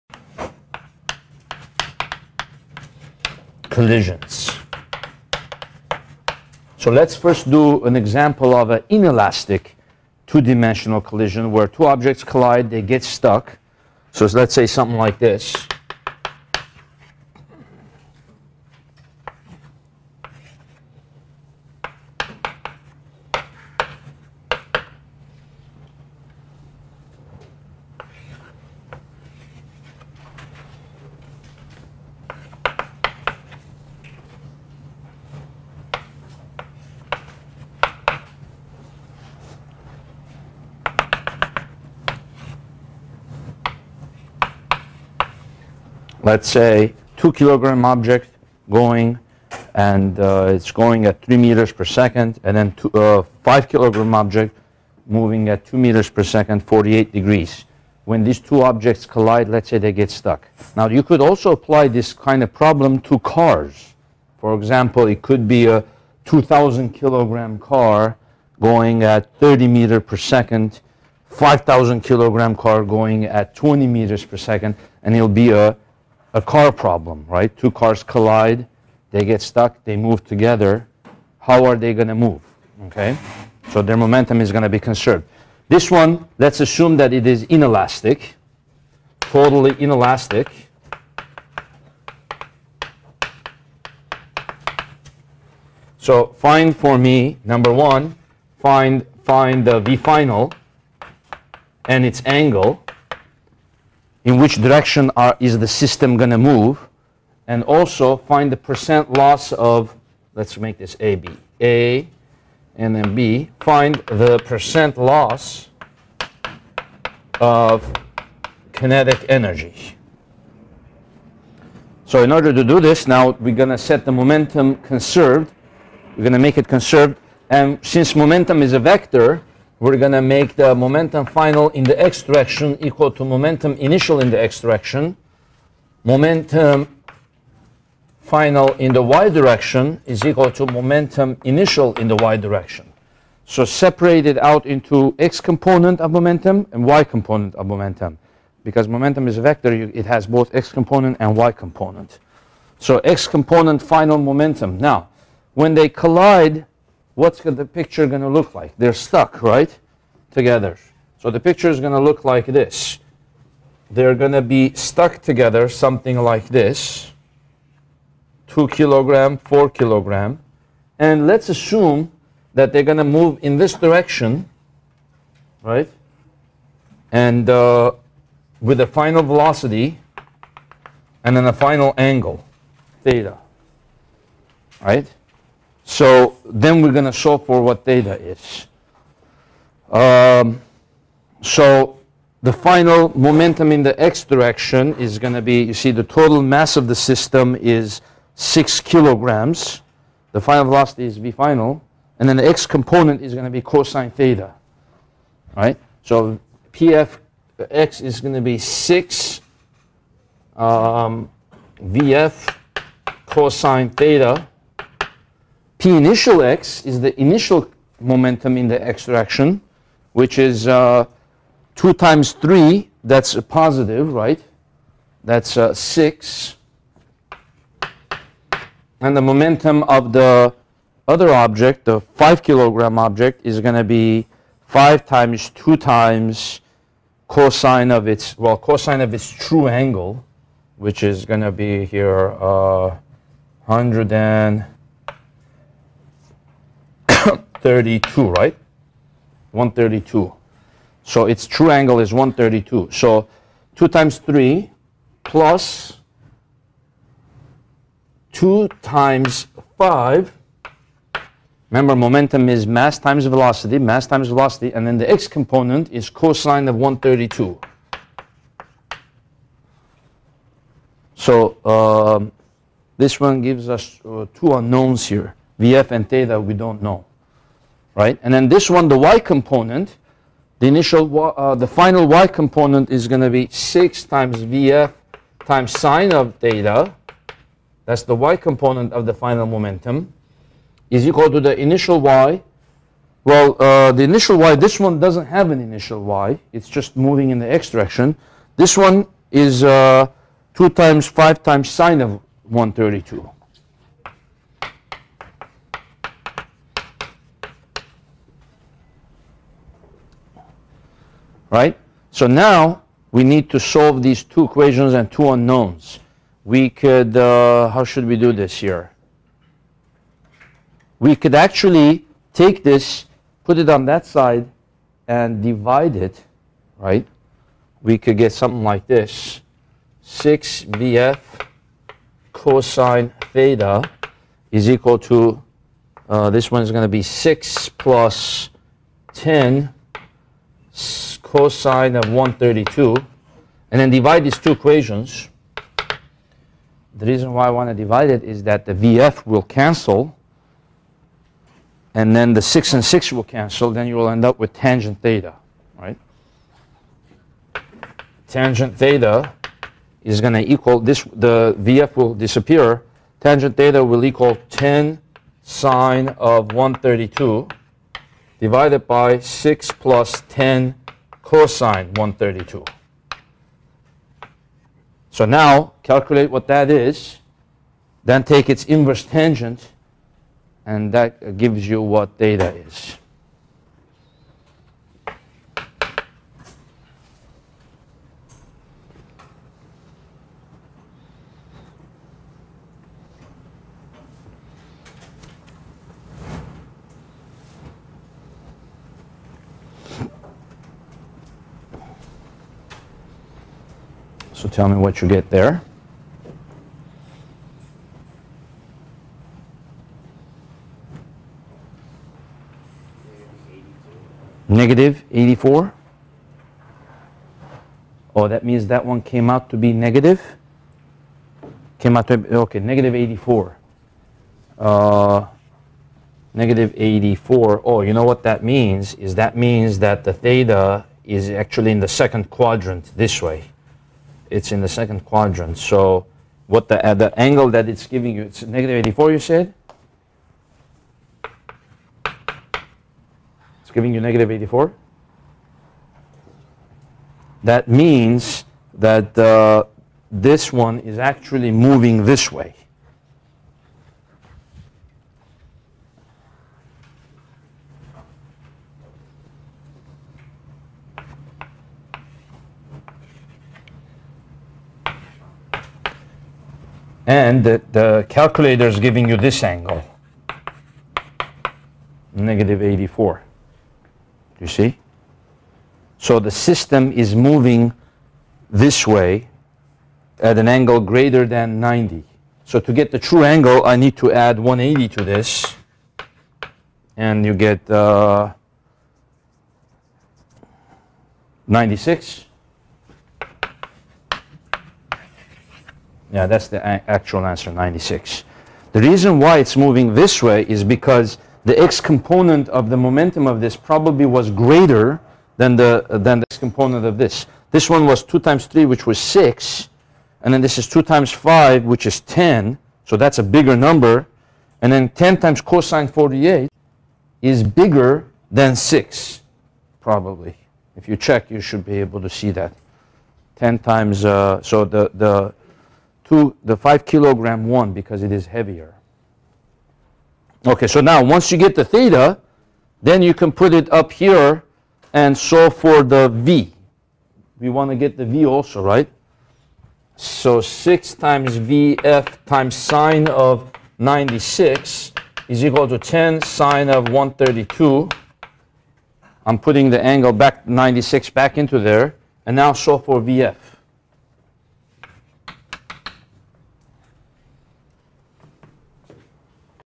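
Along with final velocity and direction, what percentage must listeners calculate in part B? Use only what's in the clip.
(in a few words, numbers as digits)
percent loss of kinetic energy.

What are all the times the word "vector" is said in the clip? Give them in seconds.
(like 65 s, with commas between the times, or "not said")
128 s, 149 s.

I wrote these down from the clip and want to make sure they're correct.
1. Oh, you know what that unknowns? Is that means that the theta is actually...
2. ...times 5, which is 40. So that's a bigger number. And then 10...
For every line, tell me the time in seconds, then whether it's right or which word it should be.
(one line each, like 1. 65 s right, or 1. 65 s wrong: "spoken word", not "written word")
1. 427 s wrong: "means", not "unknowns"
2. 510 s wrong: "10", not "40".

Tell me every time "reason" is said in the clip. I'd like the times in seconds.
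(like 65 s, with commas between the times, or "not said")
347 s, 498 s.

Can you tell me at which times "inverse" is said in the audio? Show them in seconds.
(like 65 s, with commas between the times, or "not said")
378 s.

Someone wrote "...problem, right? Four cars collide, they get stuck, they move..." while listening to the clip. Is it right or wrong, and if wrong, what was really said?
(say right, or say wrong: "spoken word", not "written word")
wrong: "Two", not "Four".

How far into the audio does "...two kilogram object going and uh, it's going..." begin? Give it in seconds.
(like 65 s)
47 s.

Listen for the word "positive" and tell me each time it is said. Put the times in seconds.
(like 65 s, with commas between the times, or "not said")
223 s.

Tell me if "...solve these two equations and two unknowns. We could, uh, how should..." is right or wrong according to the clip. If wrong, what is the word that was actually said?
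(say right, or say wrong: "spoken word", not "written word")
right.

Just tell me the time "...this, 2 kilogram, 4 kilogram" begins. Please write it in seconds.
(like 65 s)
166 s.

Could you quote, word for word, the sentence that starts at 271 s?
So uh, this one gives us uh, two unknowns here, VF and theta we don't know right?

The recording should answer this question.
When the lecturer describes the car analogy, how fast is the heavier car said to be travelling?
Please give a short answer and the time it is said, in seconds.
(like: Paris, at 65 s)
20 meters per second, at 73 s.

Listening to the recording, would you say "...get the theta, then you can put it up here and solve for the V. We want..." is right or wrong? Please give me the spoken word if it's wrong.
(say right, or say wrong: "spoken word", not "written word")
right.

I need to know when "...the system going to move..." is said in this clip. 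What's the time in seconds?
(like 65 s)
105 s.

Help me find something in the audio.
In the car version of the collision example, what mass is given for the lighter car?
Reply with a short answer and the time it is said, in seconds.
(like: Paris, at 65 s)
2000 kilograms, at 66 s.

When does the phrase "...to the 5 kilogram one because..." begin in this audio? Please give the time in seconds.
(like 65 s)
526 s.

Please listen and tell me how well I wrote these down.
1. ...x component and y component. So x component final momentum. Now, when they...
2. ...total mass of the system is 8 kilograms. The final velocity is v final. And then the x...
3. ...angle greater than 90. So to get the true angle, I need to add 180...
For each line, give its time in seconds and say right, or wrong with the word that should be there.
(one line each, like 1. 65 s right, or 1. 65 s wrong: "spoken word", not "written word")
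1. 150 s right
2. 196 s wrong: "6", not "8"
3. 480 s right.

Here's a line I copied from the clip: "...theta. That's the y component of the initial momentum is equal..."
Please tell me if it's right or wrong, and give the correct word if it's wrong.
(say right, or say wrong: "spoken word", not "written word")
wrong: "final", not "initial".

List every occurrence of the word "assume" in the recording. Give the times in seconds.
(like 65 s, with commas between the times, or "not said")
86 s, 171 s.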